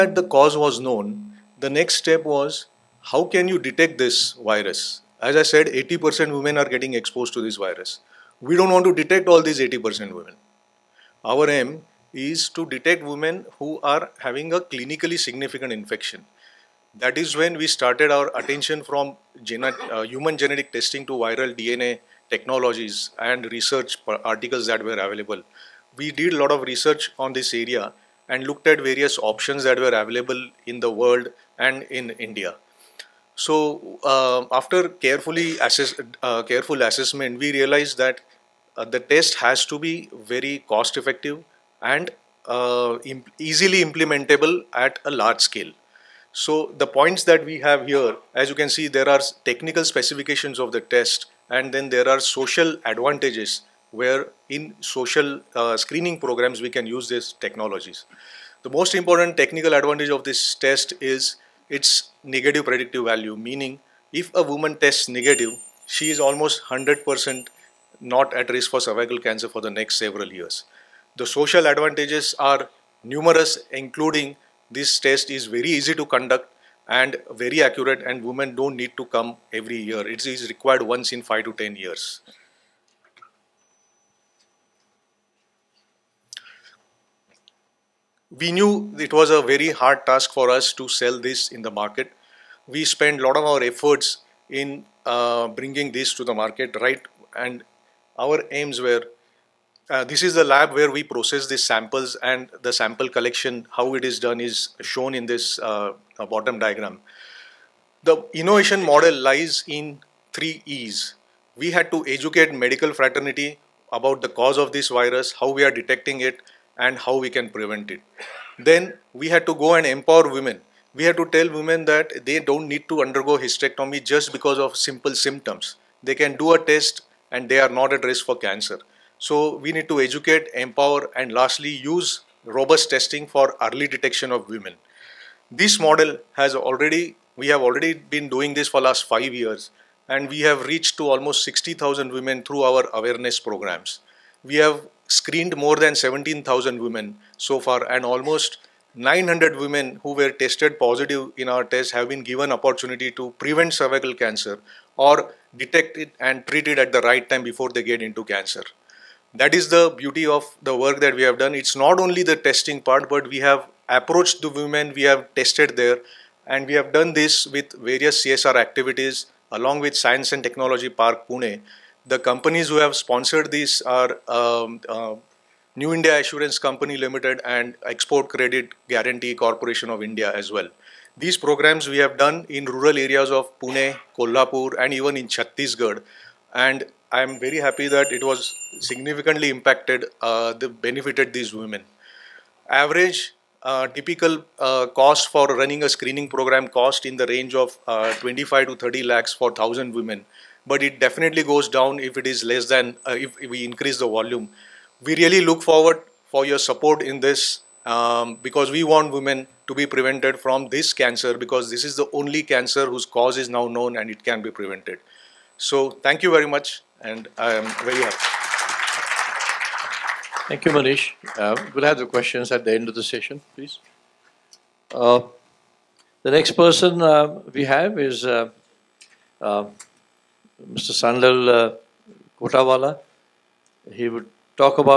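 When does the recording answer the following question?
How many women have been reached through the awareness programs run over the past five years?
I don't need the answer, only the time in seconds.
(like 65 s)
141 s.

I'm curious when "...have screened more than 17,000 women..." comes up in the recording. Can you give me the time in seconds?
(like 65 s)
144 s.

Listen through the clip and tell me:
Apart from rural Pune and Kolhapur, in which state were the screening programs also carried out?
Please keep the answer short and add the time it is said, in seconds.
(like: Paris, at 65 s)
Chhattisgarh, at 185 s.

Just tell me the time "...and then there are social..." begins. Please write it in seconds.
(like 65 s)
51 s.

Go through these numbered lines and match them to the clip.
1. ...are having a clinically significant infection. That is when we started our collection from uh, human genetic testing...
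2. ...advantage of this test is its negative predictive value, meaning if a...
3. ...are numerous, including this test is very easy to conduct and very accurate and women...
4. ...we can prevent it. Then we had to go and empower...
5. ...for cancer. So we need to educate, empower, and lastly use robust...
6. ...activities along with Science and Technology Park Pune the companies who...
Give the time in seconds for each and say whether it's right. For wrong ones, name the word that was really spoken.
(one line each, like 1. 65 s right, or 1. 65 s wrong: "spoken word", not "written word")
1. 13 s wrong: "attention", not "collection"
2. 59 s right
3. 72 s right
4. 117 s right
5. 128 s right
6. 168 s right.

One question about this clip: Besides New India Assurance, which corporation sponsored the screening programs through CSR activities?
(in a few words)
Export Credit Guarantee Corporation of India.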